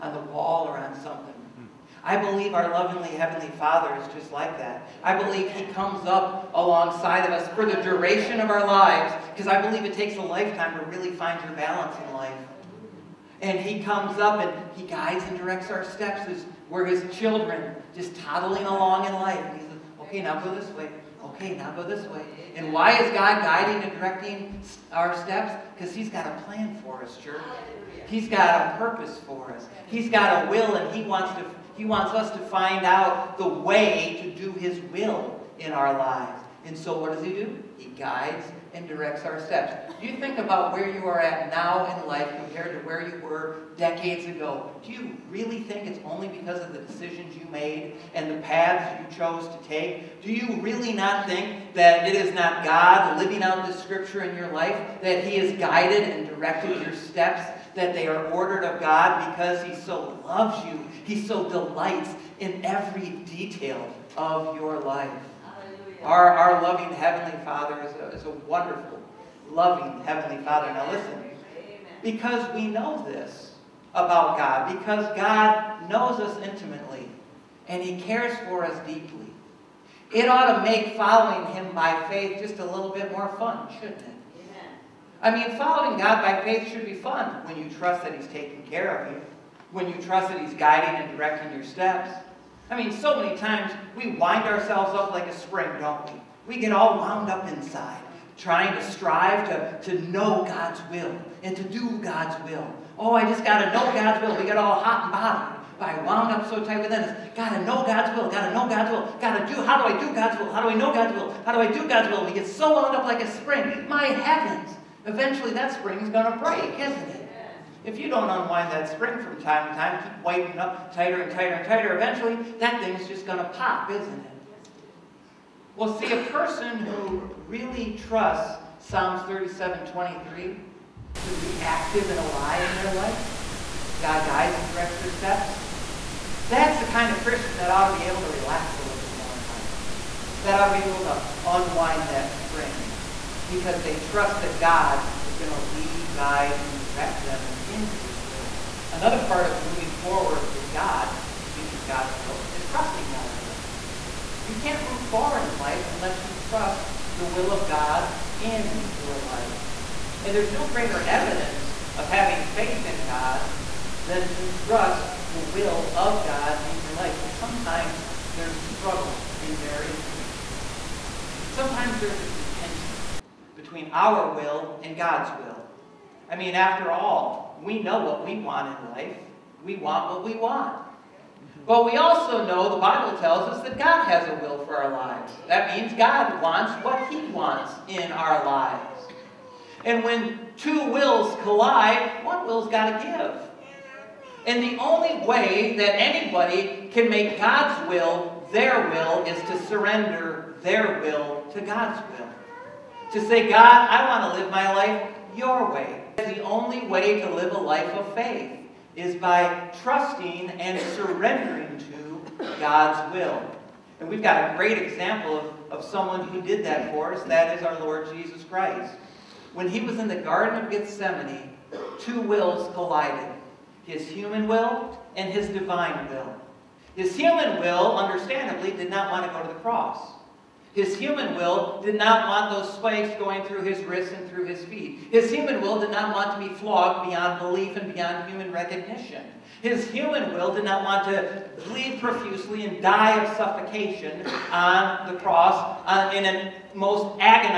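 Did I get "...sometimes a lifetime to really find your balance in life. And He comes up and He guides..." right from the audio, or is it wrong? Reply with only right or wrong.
wrong.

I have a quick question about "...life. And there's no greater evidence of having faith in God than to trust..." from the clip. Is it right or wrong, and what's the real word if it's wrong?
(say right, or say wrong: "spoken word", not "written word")
right.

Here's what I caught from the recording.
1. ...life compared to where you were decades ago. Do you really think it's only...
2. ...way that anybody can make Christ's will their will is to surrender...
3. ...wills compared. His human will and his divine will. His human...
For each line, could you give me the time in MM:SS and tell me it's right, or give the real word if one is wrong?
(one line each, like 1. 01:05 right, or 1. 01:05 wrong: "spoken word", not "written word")
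1. 00:42 right
2. 03:15 wrong: "God", not "Christ"
3. 03:42 wrong: "collided", not "compared".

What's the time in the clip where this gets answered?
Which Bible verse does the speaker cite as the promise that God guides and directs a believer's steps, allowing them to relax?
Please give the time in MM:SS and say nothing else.
02:08.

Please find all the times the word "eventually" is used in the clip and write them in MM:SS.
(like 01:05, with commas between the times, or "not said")
01:55, 02:01.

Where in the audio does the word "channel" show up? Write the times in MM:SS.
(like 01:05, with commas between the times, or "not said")
not said.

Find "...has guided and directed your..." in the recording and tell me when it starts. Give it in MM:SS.
00:55.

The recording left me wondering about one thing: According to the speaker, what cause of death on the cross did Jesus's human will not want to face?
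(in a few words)
Suffocation.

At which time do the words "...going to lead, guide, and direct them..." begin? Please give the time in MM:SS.
02:25.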